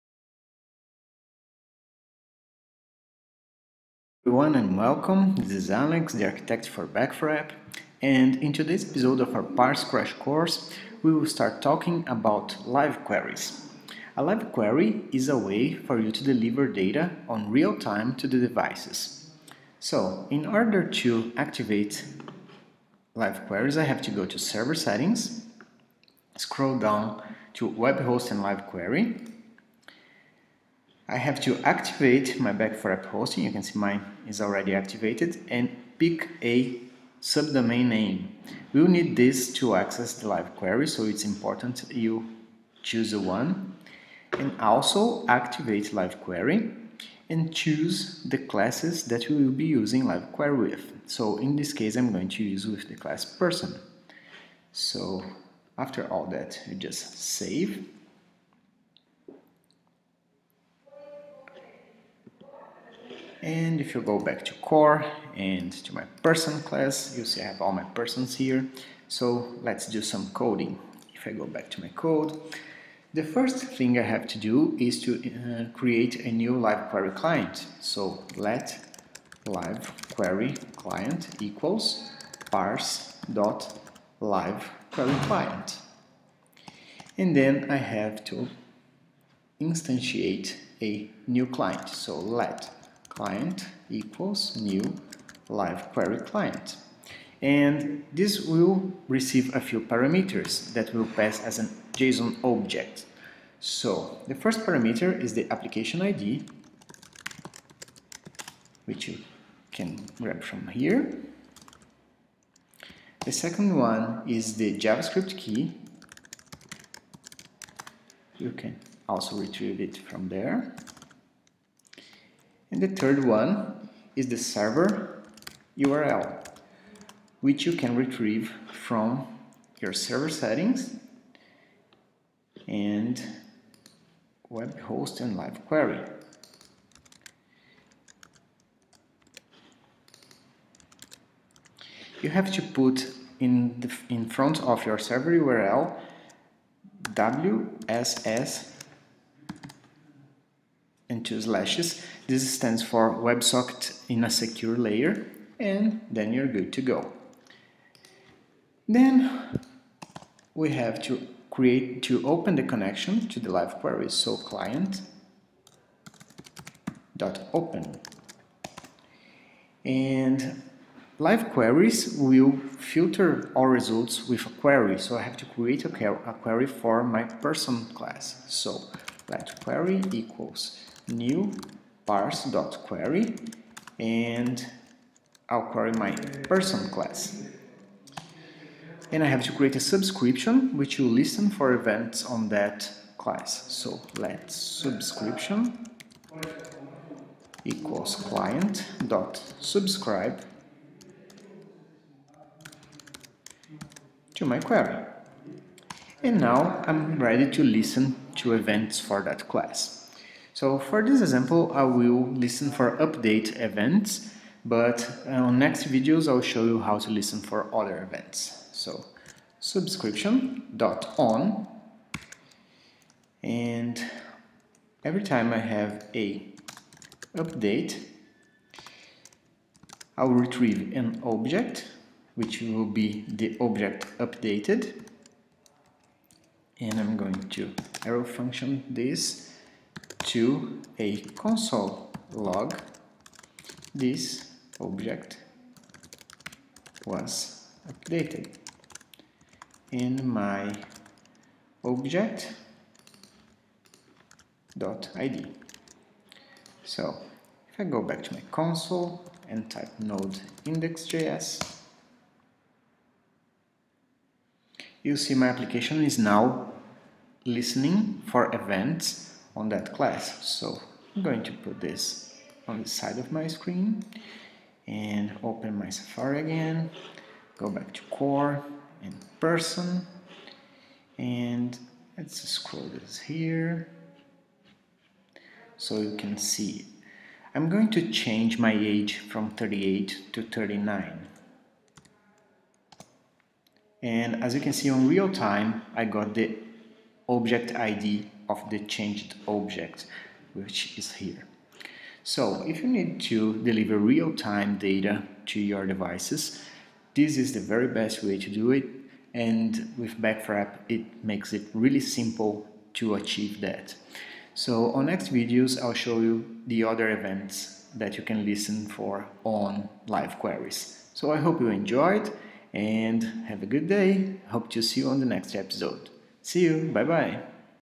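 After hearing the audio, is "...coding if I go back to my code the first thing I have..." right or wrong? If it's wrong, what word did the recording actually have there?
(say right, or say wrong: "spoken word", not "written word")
right.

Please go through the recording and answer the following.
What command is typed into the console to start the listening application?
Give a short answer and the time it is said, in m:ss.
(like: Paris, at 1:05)
node index.js, at 4:19.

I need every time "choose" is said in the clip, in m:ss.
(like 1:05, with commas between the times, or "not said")
0:42, 0:47.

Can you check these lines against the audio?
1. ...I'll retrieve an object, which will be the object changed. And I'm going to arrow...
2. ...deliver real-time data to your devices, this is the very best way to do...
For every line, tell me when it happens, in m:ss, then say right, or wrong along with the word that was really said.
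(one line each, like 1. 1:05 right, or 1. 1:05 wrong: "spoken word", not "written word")
1. 3:50 wrong: "updated", not "changed"
2. 5:03 right.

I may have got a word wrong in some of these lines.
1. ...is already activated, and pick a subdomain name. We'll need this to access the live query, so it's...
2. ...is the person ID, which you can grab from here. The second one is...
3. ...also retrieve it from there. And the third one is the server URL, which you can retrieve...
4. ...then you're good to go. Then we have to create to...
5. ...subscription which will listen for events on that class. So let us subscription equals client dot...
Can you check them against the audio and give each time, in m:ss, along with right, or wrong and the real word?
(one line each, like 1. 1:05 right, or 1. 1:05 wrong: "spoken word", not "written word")
1. 0:34 right
2. 1:45 wrong: "application", not "person"
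3. 1:59 right
4. 2:36 right
5. 3:09 right.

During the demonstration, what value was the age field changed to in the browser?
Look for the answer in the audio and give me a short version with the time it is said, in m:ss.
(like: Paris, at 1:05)
39, at 4:50.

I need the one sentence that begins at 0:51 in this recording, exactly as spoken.
So in this case, I'm going to use with the class person.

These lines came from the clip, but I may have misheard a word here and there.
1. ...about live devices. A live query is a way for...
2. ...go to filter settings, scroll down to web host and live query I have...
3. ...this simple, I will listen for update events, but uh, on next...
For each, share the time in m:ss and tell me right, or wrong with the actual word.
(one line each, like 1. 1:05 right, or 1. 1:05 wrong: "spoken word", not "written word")
1. 0:12 wrong: "queries", not "devices"
2. 0:24 wrong: "server", not "filter"
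3. 3:31 wrong: "example", not "simple".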